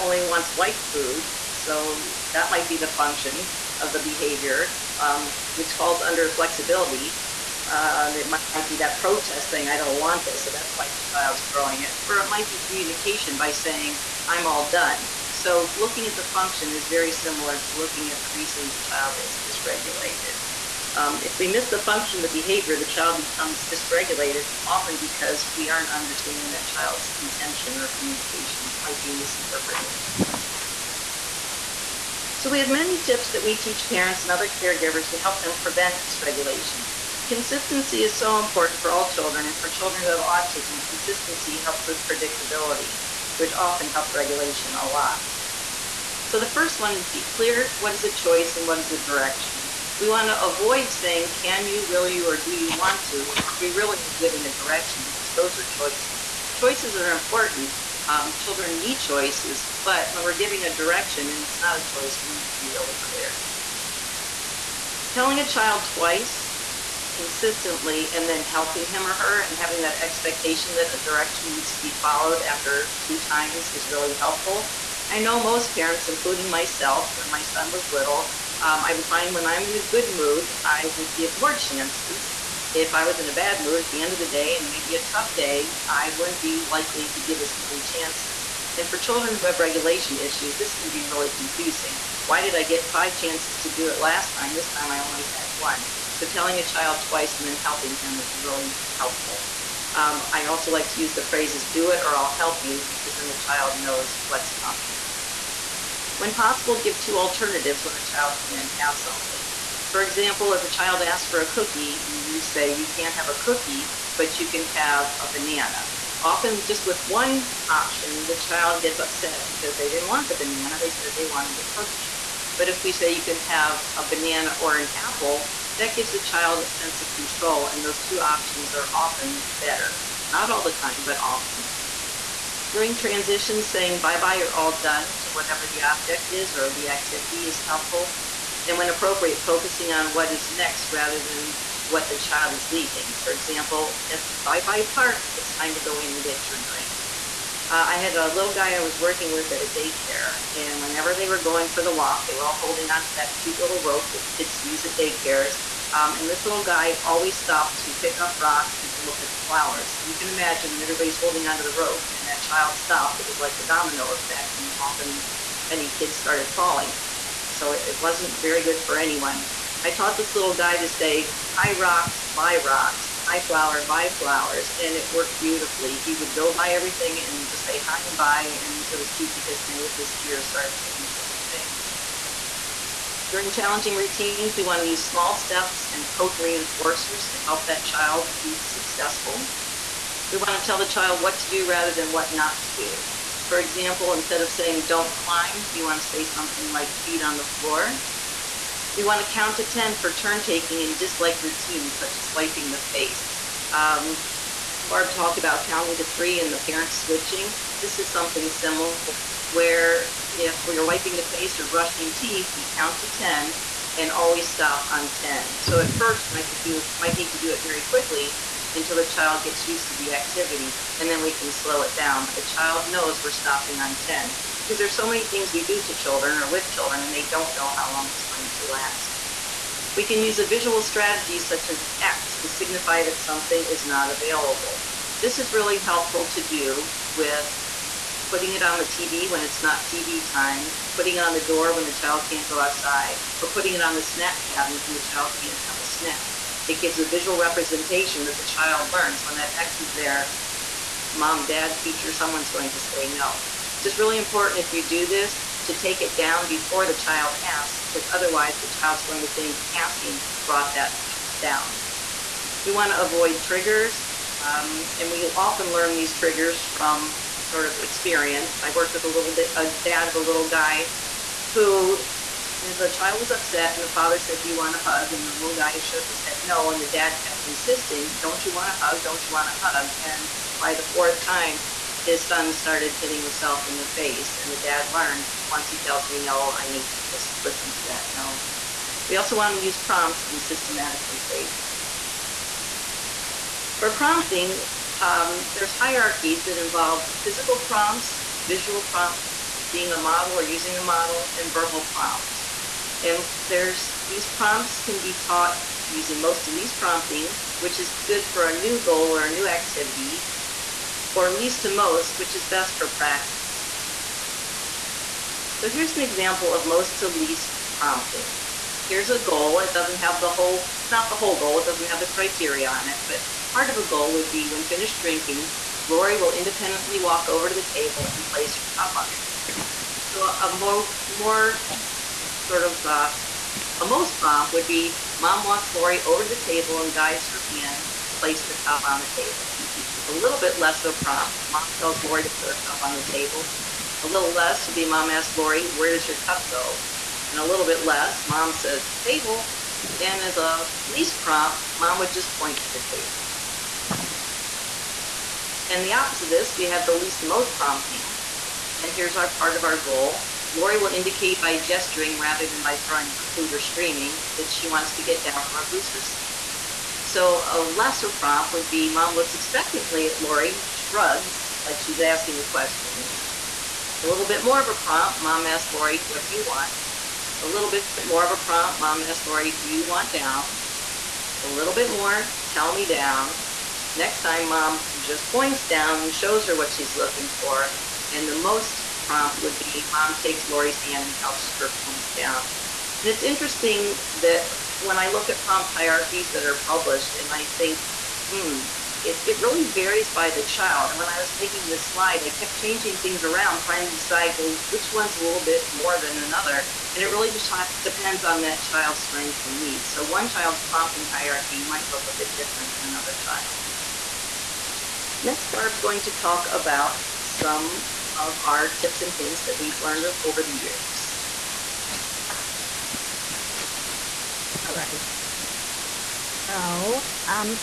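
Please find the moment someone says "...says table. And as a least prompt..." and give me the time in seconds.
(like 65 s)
348 s.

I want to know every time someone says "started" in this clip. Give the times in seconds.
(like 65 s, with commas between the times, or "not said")
166 s, 180 s, 282 s.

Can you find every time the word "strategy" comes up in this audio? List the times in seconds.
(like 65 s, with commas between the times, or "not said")
230 s.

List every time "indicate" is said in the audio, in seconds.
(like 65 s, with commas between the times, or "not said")
360 s.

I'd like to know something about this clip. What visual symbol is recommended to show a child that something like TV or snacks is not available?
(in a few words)
an X.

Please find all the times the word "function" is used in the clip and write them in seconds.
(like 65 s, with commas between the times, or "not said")
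2 s, 16 s, 21 s.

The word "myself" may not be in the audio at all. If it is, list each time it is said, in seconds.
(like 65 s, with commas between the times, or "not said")
76 s.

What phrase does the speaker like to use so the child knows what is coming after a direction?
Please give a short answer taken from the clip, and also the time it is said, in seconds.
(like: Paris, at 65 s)
do it or I'll help you, at 101 s.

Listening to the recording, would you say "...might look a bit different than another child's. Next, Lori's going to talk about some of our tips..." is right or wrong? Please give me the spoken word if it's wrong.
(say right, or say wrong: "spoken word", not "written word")
wrong: "Barb", not "Lori".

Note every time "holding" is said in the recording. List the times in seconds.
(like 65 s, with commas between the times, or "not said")
152 s, 161 s.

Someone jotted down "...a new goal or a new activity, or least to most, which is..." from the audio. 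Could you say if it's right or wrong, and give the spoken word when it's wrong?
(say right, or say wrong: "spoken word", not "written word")
right.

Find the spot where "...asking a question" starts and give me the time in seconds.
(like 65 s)
372 s.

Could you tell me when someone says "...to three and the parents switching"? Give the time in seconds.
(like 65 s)
205 s.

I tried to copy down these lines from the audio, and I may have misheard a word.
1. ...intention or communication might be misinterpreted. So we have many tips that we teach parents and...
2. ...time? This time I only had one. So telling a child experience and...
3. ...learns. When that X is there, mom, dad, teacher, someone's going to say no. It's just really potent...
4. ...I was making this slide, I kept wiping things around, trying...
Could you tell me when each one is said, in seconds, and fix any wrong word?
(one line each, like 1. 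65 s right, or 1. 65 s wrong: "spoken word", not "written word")
1. 27 s right
2. 94 s wrong: "twice", not "experience"
3. 248 s wrong: "important", not "potent"
4. 401 s wrong: "changing", not "wiping".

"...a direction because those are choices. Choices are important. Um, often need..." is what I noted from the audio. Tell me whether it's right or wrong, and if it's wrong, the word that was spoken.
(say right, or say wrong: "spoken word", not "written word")
wrong: "children", not "often".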